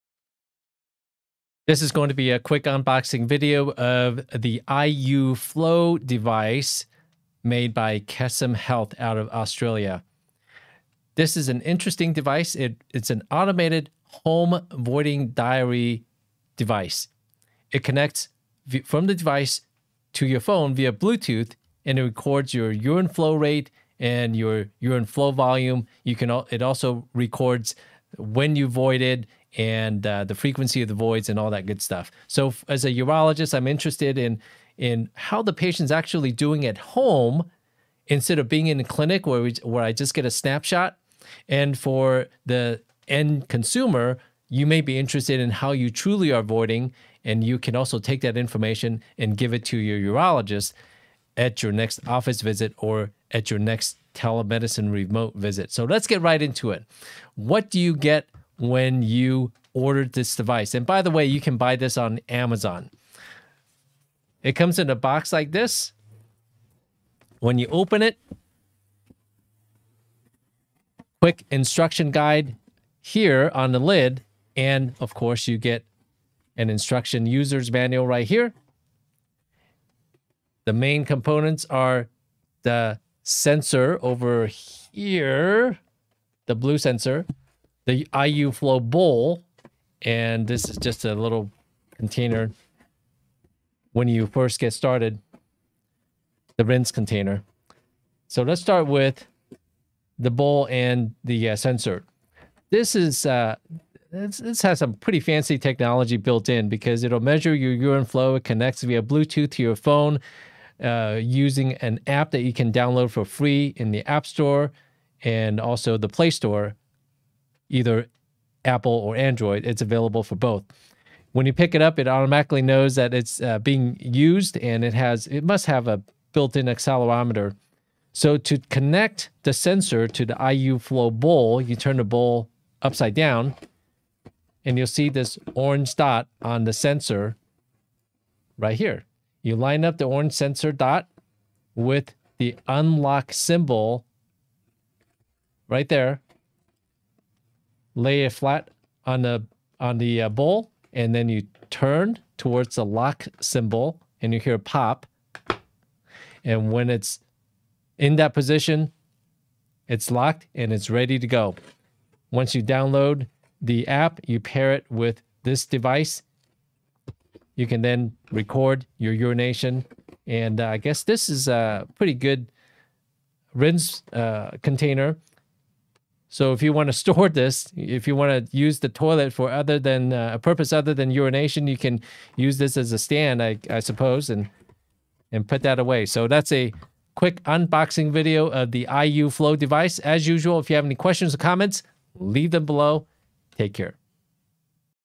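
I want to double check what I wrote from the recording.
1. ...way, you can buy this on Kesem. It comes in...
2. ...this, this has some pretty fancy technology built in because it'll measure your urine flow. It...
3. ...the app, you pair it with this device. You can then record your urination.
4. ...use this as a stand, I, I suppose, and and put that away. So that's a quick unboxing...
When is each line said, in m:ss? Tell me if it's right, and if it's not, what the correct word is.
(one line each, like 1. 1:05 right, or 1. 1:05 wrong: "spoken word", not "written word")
1. 1:01 wrong: "Amazon", not "Kesem"
2. 1:44 right
3. 2:43 right
4. 3:02 right.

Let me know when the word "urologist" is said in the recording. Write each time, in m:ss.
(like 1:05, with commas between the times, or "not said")
0:32, 0:50.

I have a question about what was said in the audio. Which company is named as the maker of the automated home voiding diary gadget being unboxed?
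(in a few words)
Kesem Health.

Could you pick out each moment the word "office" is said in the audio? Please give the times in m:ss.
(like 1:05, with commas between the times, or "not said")
0:52.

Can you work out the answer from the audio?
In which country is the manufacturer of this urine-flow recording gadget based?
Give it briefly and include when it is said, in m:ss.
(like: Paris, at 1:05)
Australia, at 0:09.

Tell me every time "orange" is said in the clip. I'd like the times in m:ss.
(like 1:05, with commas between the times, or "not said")
2:15, 2:20.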